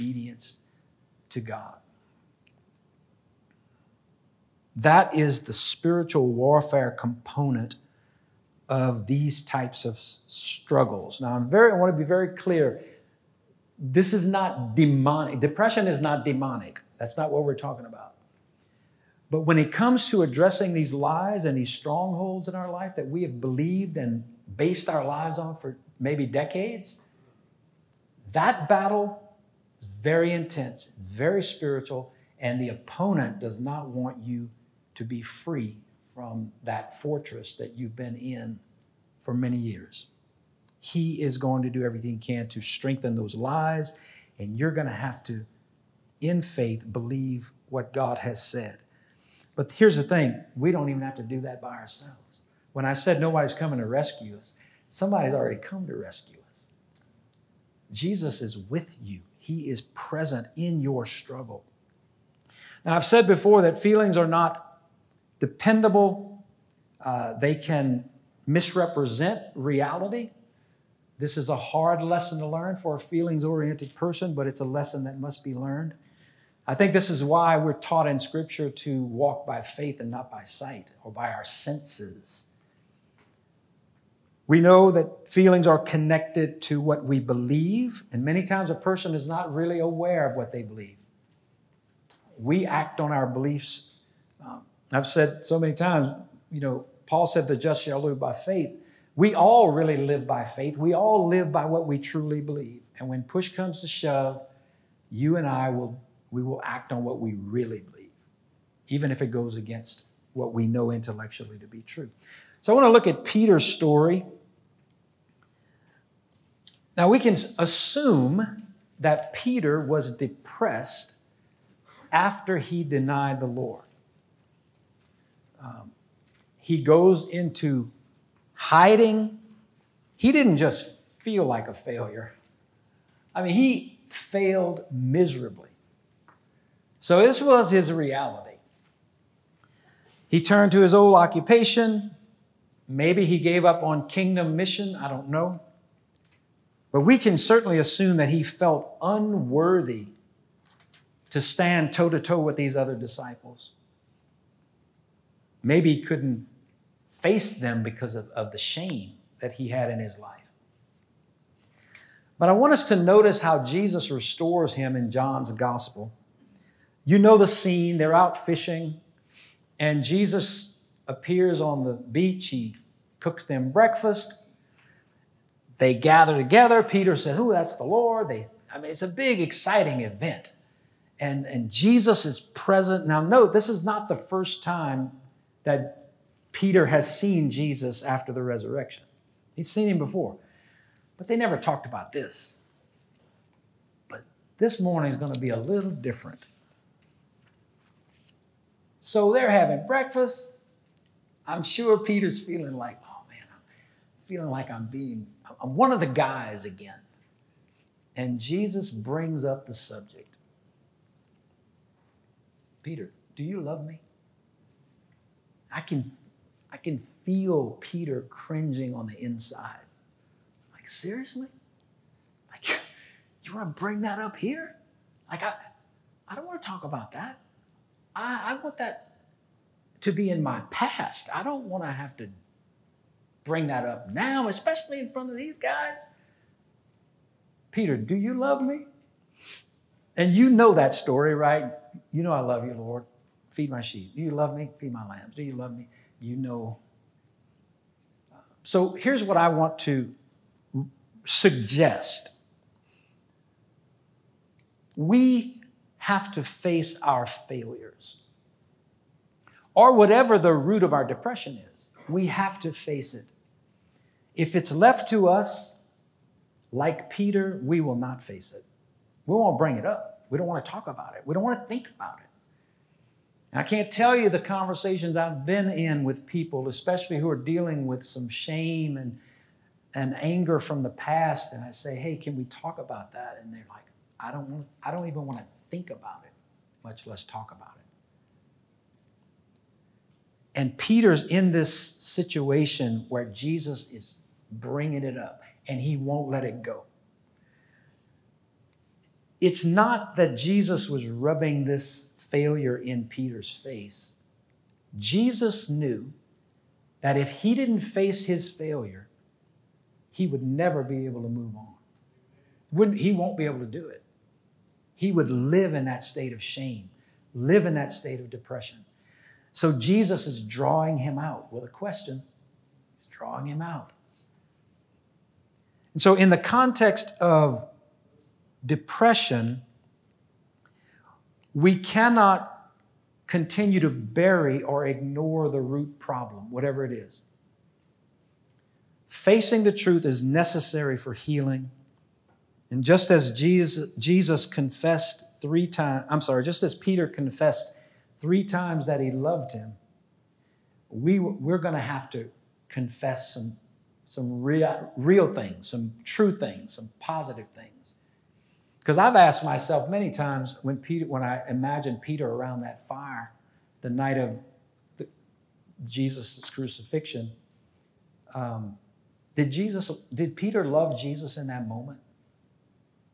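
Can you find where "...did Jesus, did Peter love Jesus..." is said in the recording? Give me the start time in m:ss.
6:09.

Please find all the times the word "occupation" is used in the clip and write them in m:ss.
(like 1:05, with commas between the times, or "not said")
2:21.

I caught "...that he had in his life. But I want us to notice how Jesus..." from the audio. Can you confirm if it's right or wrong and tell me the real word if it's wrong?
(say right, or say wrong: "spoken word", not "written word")
right.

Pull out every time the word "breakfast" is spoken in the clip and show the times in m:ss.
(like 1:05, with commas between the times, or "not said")
2:53, 3:19.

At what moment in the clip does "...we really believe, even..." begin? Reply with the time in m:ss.
1:47.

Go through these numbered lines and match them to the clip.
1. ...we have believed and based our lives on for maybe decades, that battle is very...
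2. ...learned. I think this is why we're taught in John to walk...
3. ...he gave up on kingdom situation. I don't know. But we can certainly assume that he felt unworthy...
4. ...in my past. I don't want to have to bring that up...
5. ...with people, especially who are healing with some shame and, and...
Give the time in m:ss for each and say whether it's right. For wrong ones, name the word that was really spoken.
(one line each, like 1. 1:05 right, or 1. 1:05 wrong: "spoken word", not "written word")
1. 0:23 right
2. 1:15 wrong: "Scripture", not "John"
3. 2:23 wrong: "mission", not "situation"
4. 3:50 right
5. 4:36 wrong: "dealing", not "healing".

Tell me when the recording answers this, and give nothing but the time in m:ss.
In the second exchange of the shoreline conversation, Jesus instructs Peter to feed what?
4:04.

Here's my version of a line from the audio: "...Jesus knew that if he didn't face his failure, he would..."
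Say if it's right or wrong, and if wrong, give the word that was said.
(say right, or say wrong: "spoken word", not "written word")
right.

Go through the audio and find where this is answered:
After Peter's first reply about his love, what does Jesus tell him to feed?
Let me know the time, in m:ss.
4:03.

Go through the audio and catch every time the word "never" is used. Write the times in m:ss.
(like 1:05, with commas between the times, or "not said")
3:11, 5:10.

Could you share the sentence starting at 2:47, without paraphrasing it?
You know the scene, they're out fishing, and Jesus appears on the beach.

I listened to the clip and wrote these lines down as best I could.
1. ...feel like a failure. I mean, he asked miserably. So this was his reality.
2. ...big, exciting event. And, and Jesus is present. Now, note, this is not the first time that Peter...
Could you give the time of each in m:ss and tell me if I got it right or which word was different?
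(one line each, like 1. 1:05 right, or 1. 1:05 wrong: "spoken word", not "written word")
1. 2:11 wrong: "failed", not "asked"
2. 2:59 right.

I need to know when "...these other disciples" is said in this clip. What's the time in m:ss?
2:32.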